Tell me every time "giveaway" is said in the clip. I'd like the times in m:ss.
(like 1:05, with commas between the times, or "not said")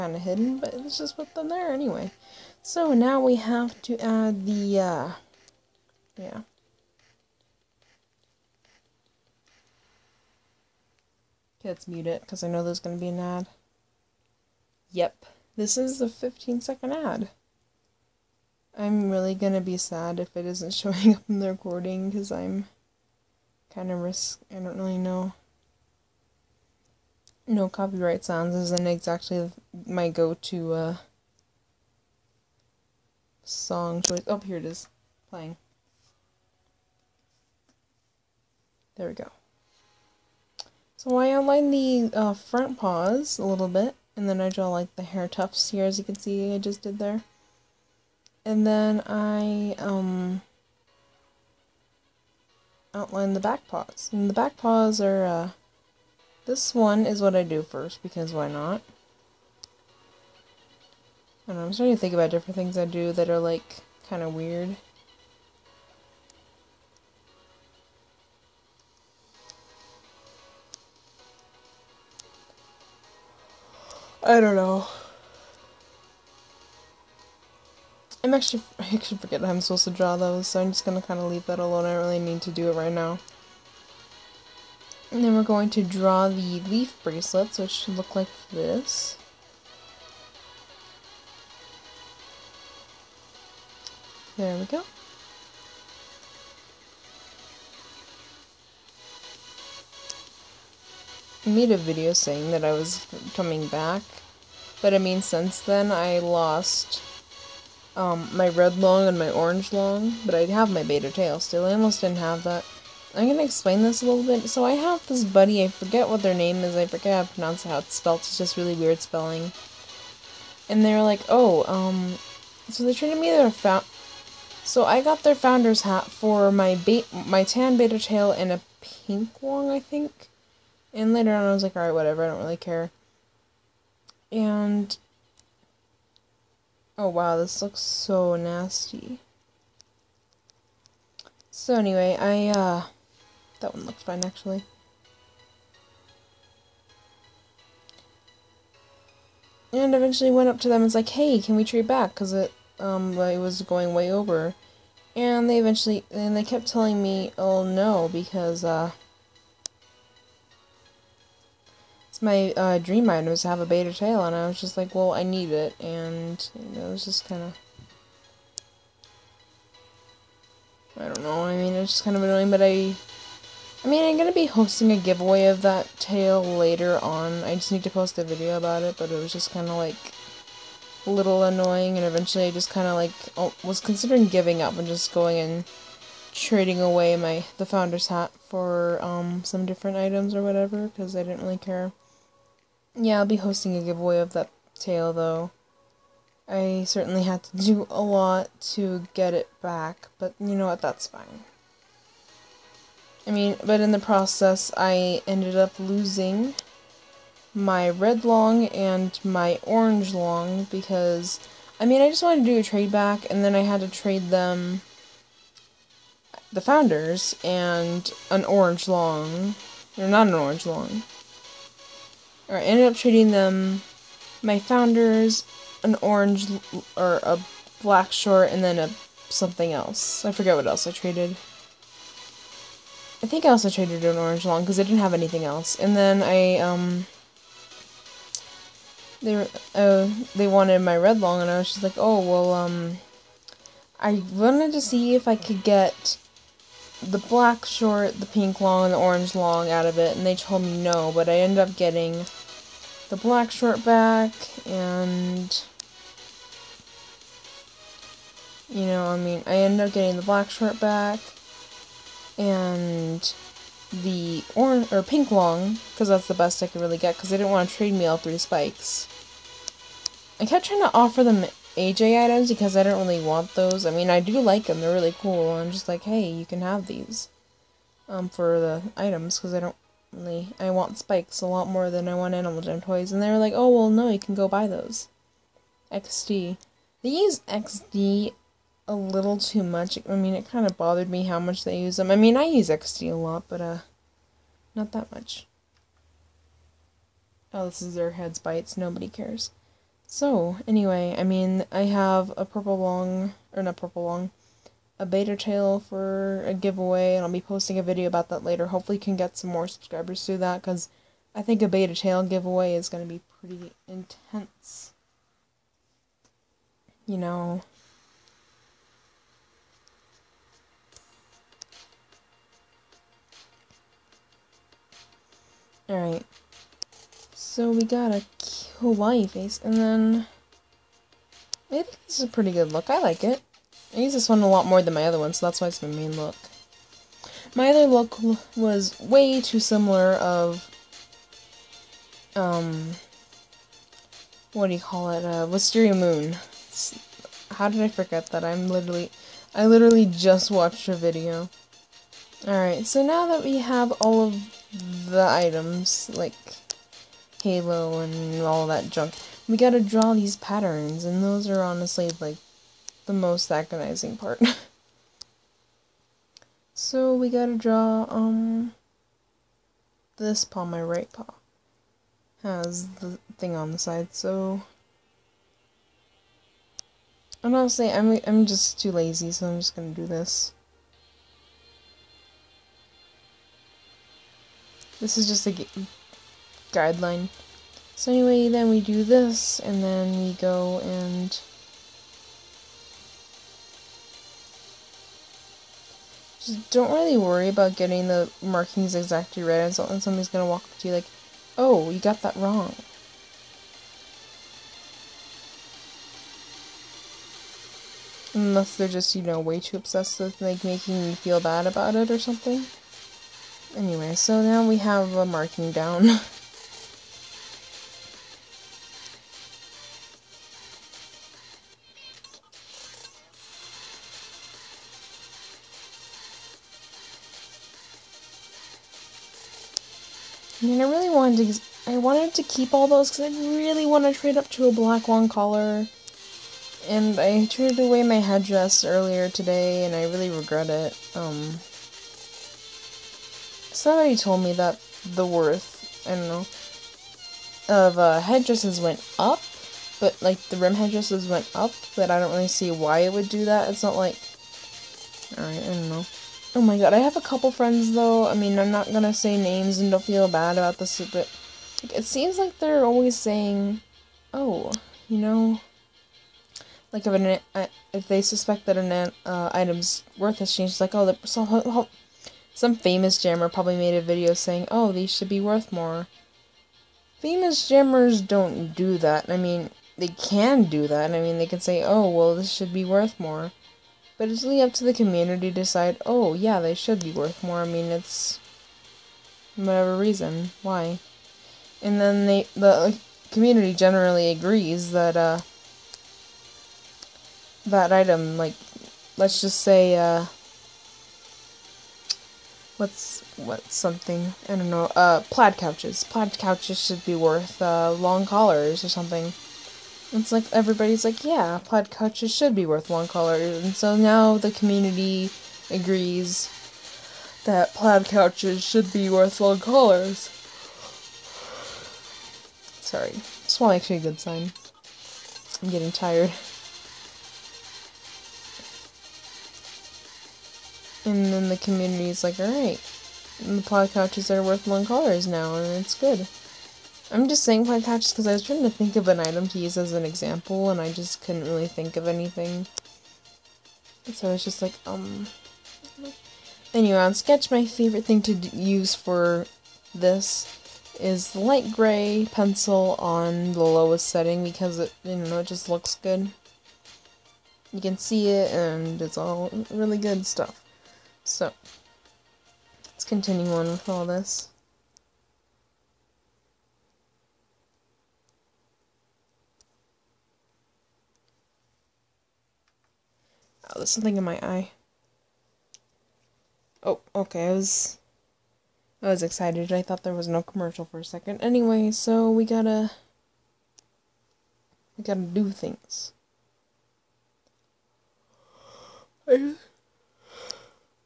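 2:54, 3:13, 5:06, 5:12.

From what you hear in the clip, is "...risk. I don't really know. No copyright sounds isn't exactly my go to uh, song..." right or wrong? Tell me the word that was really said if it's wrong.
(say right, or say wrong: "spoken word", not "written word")
right.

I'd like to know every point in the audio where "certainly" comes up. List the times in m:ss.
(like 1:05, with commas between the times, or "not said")
3:16.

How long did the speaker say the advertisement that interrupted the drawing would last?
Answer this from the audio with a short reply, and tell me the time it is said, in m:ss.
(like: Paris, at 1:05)
15 seconds, at 0:16.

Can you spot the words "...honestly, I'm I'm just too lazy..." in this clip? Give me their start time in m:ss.
6:17.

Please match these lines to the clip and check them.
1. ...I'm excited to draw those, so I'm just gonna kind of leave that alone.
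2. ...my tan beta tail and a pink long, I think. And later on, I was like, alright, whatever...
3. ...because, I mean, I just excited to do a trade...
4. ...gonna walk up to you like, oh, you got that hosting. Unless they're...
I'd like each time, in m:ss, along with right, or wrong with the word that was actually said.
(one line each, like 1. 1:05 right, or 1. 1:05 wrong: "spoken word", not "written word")
1. 1:19 wrong: "supposed", not "excited"
2. 2:07 right
3. 3:30 wrong: "wanted", not "excited"
4. 6:40 wrong: "wrong", not "hosting".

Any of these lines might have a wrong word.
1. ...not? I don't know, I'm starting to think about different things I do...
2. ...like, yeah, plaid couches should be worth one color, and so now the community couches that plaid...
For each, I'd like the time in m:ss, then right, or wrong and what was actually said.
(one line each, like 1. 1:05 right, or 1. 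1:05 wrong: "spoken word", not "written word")
1. 0:58 right
2. 8:31 wrong: "agrees", not "couches".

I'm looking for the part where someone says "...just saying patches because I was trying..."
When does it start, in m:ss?
8:57.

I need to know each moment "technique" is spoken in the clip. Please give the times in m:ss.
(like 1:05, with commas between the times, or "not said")
not said.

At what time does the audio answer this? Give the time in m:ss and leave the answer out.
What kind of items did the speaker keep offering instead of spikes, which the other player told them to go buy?
4:31.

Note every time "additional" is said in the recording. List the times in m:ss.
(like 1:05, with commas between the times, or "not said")
not said.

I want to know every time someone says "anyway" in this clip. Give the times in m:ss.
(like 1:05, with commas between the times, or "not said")
0:01, 2:21, 5:00, 6:28, 6:53, 9:06, 9:41.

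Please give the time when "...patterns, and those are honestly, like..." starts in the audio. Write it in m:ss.
6:00.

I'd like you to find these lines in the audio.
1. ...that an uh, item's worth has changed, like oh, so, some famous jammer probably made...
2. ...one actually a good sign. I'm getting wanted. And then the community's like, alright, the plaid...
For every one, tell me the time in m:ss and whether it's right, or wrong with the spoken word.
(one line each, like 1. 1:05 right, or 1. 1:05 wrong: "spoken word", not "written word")
1. 7:48 right
2. 8:43 wrong: "tired", not "wanted".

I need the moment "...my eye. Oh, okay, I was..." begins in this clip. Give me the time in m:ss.
9:34.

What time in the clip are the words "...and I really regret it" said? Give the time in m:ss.
7:19.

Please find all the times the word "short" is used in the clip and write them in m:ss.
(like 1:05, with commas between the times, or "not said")
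3:48, 4:07, 4:13, 4:20.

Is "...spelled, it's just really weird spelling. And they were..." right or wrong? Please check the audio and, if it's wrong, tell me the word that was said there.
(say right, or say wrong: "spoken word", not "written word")
right.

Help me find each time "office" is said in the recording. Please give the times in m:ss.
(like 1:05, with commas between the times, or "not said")
not said.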